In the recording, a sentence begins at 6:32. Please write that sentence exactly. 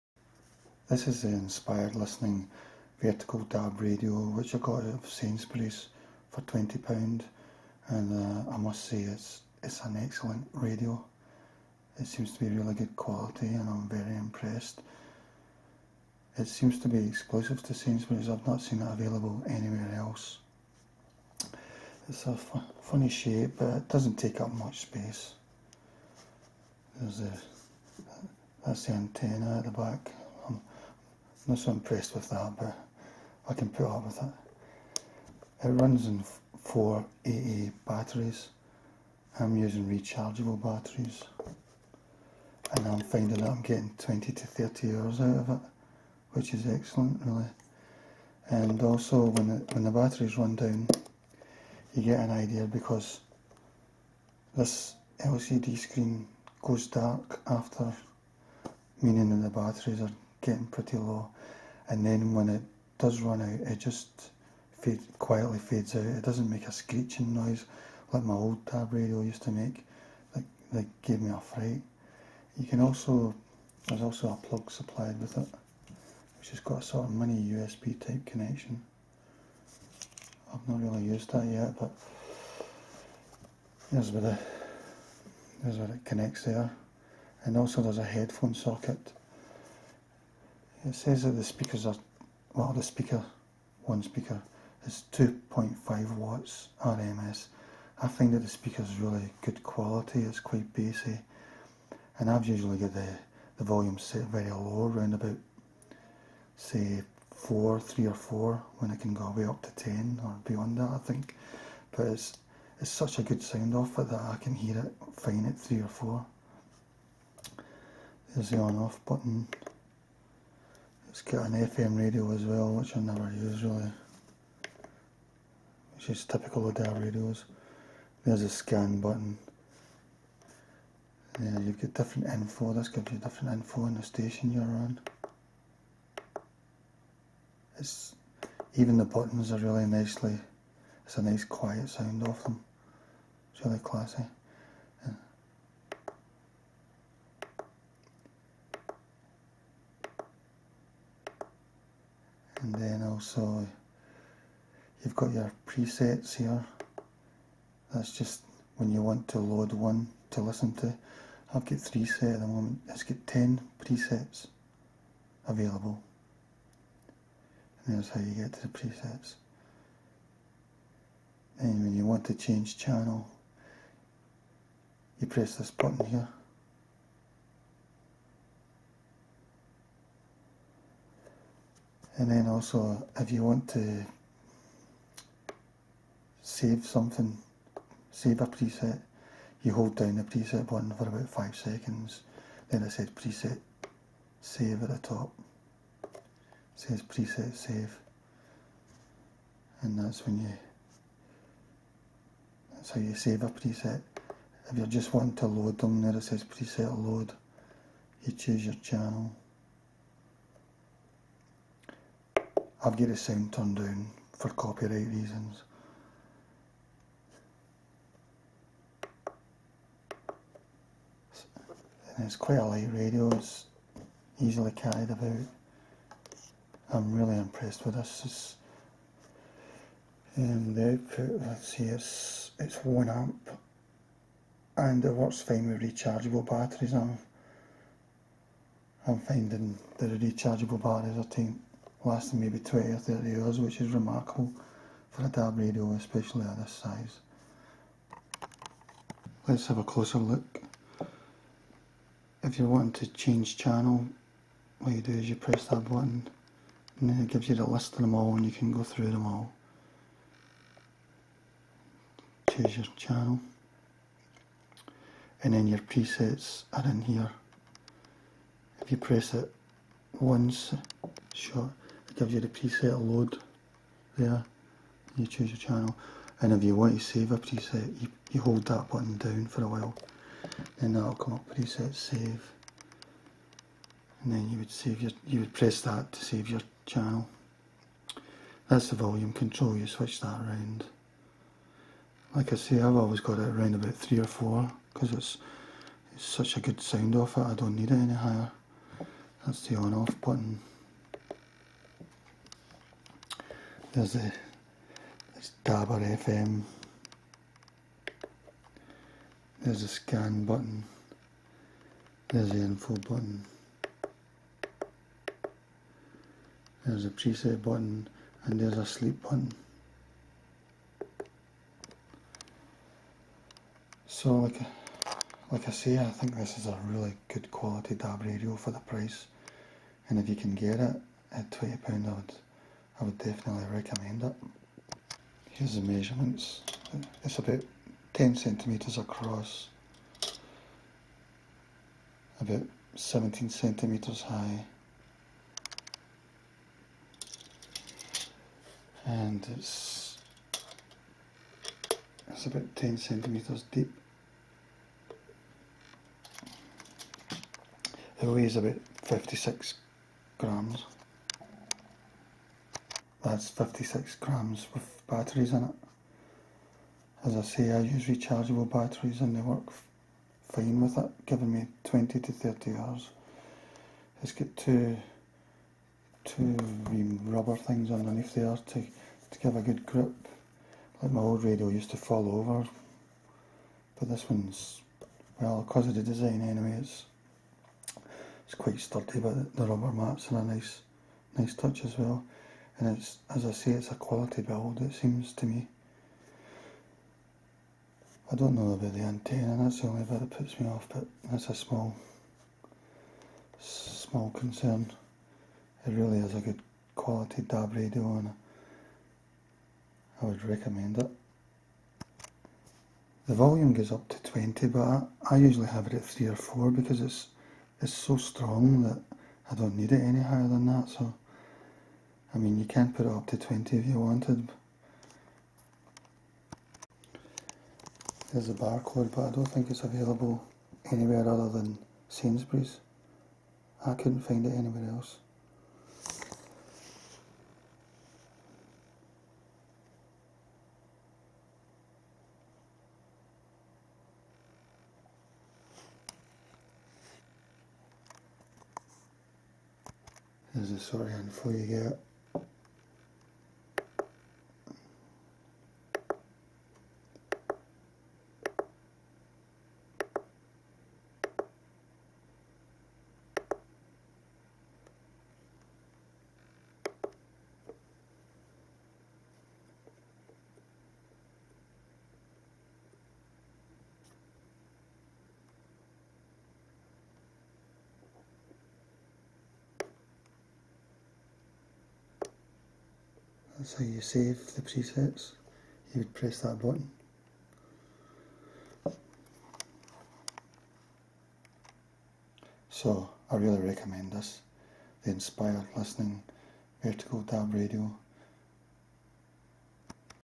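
And it's, as I say, it's a quality build, it seems to me.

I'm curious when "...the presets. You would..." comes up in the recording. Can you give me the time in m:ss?
8:04.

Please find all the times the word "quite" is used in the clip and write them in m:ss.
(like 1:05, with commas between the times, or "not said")
1:40, 3:42, 6:28.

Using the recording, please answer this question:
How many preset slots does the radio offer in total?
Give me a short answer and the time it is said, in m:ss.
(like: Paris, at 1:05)
10, at 2:43.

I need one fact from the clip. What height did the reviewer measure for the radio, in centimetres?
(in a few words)
17 centimetres.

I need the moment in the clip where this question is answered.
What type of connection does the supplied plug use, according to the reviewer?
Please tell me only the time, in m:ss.
1:17.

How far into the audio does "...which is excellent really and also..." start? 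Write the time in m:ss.
0:46.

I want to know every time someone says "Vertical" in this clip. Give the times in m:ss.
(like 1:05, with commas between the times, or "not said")
0:02, 8:16.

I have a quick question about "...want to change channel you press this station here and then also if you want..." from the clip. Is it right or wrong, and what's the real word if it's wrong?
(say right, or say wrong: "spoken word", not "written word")
wrong: "button", not "station".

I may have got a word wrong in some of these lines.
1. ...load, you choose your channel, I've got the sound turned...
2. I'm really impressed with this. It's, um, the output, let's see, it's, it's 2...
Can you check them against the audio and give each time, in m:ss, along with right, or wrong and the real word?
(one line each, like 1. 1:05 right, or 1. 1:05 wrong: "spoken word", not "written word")
1. 3:27 right
2. 3:46 wrong: "1", not "2".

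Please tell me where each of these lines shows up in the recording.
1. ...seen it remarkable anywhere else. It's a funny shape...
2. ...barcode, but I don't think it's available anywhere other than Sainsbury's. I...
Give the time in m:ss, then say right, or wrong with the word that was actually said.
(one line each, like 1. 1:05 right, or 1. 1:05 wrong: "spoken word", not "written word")
1. 0:18 wrong: "available", not "remarkable"
2. 7:08 right.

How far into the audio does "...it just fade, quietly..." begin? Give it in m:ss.
1:03.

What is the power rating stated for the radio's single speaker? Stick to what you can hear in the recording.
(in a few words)
2.5 watts RMS.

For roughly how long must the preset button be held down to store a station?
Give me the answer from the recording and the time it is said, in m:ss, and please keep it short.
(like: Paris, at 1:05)
5 seconds, at 3:11.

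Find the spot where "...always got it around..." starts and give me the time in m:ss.
4:52.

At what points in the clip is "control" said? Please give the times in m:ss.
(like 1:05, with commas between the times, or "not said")
4:49.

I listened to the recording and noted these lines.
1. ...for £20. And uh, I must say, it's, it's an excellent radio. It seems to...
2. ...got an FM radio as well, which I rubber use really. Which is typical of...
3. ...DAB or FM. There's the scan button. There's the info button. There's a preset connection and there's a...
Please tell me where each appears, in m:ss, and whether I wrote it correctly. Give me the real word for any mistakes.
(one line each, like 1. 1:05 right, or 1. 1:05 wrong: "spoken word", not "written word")
1. 0:06 right
2. 2:01 wrong: "never", not "rubber"
3. 5:05 wrong: "button", not "connection".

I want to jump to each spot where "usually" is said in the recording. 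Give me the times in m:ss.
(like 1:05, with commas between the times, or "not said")
1:42, 6:55.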